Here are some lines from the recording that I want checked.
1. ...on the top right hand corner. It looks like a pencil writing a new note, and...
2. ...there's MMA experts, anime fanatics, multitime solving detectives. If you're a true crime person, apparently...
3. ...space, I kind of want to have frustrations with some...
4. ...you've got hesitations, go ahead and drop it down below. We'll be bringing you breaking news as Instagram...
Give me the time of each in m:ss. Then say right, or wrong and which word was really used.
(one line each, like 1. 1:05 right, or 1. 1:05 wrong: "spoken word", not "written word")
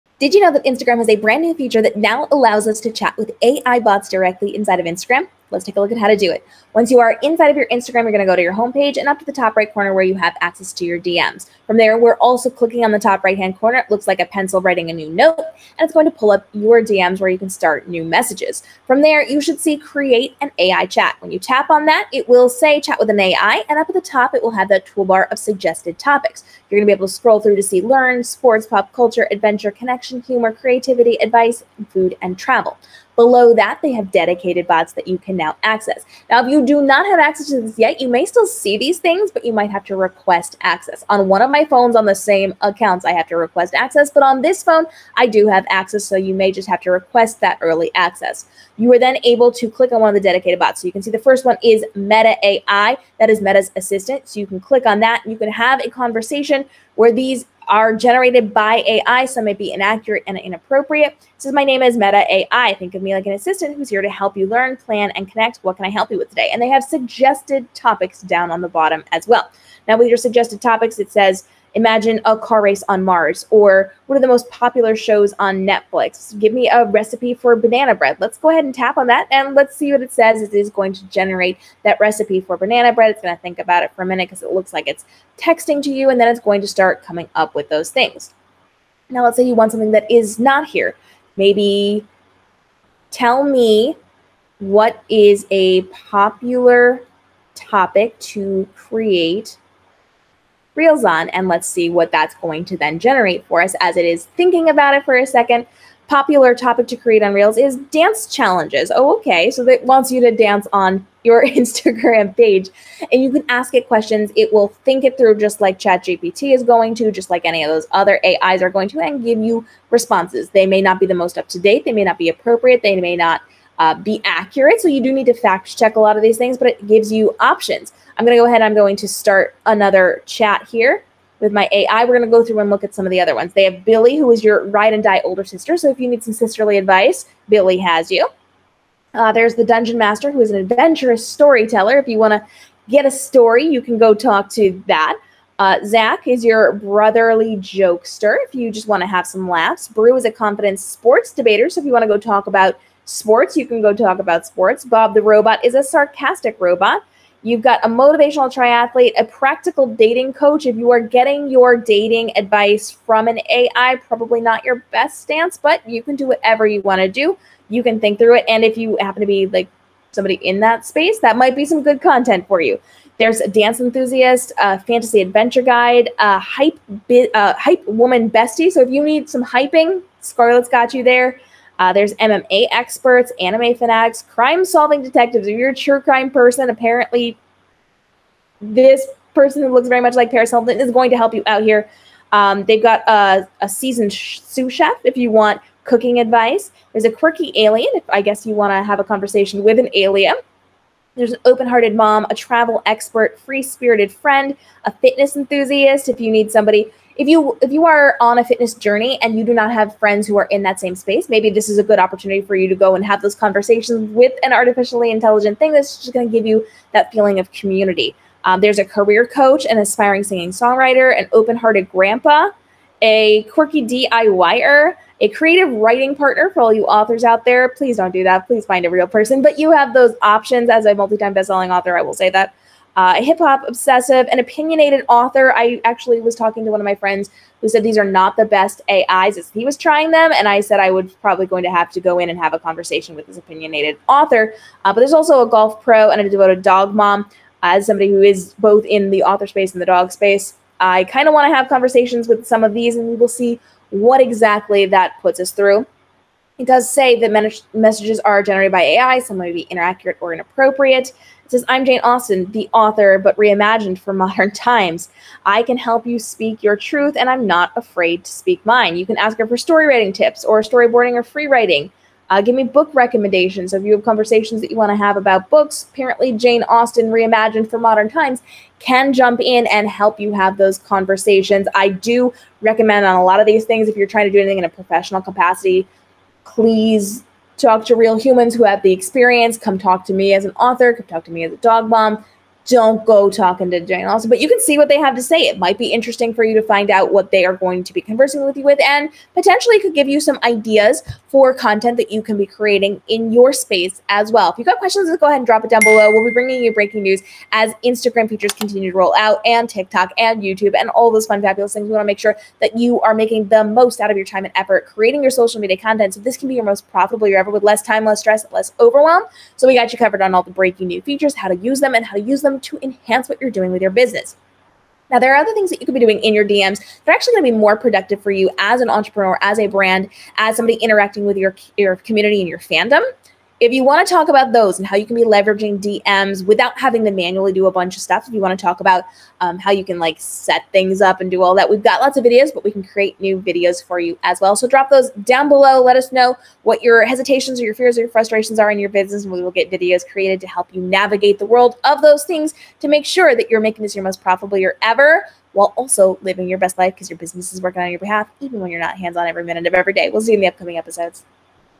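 1. 0:12 right
2. 3:01 wrong: "crime", not "multitime"
3. 4:10 wrong: "conversations", not "frustrations"
4. 5:04 wrong: "questions", not "hesitations".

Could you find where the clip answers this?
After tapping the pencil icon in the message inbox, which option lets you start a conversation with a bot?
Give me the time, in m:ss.
0:19.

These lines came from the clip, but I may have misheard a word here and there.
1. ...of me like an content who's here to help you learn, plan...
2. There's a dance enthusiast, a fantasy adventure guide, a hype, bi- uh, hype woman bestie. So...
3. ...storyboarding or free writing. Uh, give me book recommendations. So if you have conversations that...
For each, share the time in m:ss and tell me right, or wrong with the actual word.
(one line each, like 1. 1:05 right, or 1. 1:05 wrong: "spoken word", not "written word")
1. 1:02 wrong: "assistant", not "content"
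2. 2:53 right
3. 4:30 right.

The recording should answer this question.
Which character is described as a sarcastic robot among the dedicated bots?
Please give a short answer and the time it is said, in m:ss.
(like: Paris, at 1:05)
Bob the Robot, at 2:34.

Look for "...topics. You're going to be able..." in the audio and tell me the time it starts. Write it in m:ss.
0:25.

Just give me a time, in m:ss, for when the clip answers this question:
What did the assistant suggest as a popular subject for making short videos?
1:47.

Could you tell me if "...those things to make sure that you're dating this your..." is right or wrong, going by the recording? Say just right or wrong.
wrong.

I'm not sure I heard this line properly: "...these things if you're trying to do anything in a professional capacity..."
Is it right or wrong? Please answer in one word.
right.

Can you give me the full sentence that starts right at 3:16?
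There's a quirky alien if I guess you want to have a conversation with an alien.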